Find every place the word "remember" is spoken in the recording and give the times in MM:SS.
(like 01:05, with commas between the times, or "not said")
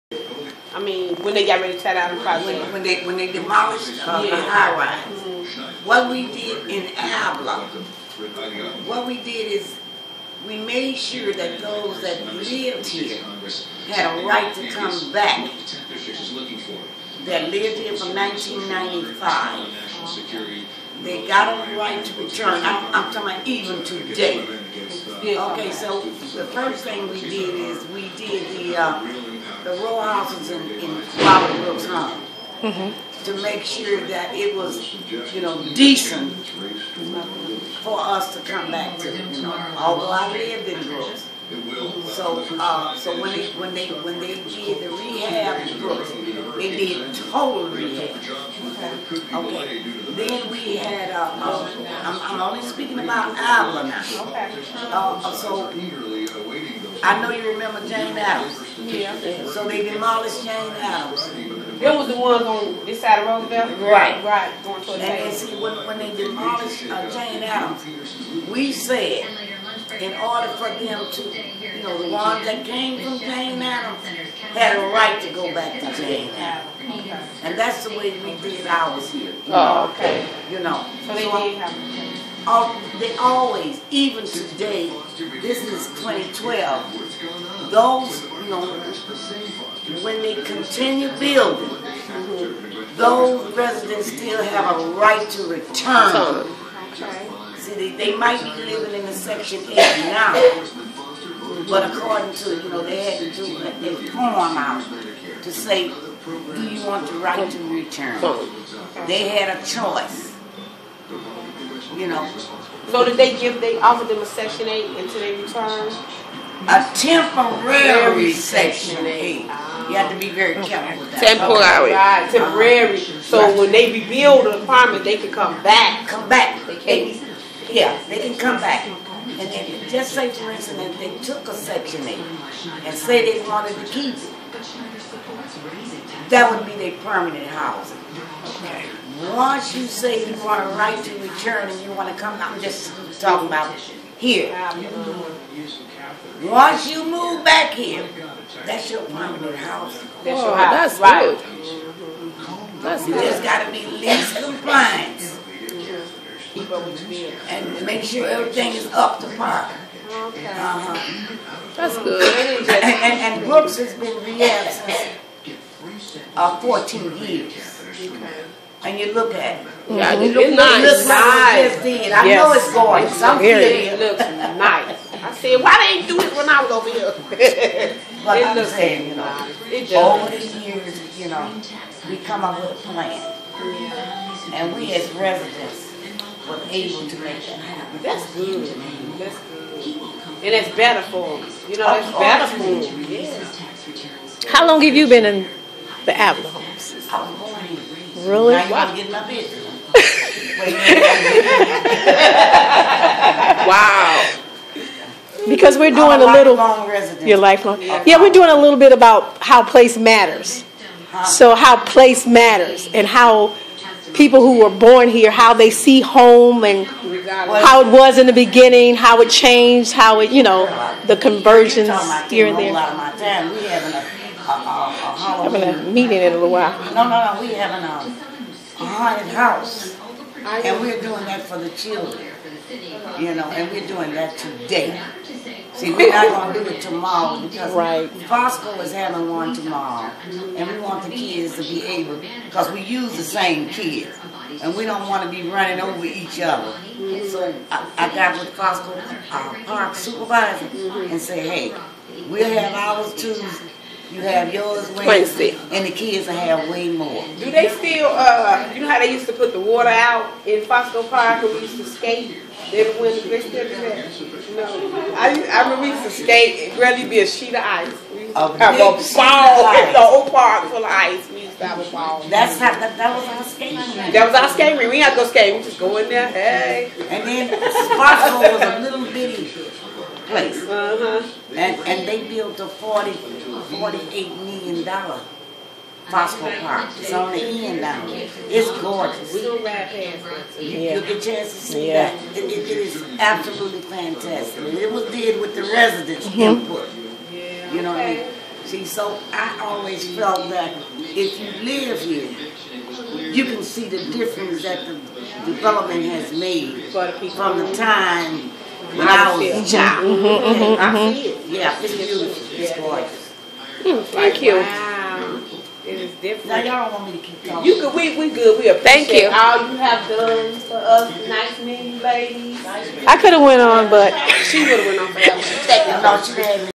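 00:57, 04:25.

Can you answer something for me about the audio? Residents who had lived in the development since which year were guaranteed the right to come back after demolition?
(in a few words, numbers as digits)
1995.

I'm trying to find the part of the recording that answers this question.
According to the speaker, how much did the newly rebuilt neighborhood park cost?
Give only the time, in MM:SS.
04:43.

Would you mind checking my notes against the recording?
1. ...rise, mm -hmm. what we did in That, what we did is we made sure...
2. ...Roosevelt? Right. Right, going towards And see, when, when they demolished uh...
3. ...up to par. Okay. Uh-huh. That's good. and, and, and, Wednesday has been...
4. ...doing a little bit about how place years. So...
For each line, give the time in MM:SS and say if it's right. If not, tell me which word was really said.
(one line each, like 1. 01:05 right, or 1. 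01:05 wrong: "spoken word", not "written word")
1. 00:04 wrong: "Abla", not "That"
2. 01:03 right
3. 02:38 wrong: "Brooks", not "Wednesday"
4. 03:28 wrong: "matters", not "years".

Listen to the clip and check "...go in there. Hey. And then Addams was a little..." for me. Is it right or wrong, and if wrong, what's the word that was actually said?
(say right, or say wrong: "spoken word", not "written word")
wrong: "Sparkle", not "Addams".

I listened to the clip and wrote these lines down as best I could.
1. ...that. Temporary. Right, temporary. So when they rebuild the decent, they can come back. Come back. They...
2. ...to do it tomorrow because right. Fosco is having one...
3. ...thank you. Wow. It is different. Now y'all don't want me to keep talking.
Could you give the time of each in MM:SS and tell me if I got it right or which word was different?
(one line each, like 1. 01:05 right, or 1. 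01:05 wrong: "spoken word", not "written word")
1. 02:01 wrong: "apartment", not "decent"
2. 03:56 right
3. 05:14 right.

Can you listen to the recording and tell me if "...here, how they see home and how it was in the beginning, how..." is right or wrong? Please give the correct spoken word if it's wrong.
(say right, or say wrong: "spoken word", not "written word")
right.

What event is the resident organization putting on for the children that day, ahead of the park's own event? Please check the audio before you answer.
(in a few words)
A haunted house.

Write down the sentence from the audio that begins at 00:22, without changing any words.
I'm, I'm talking about even today.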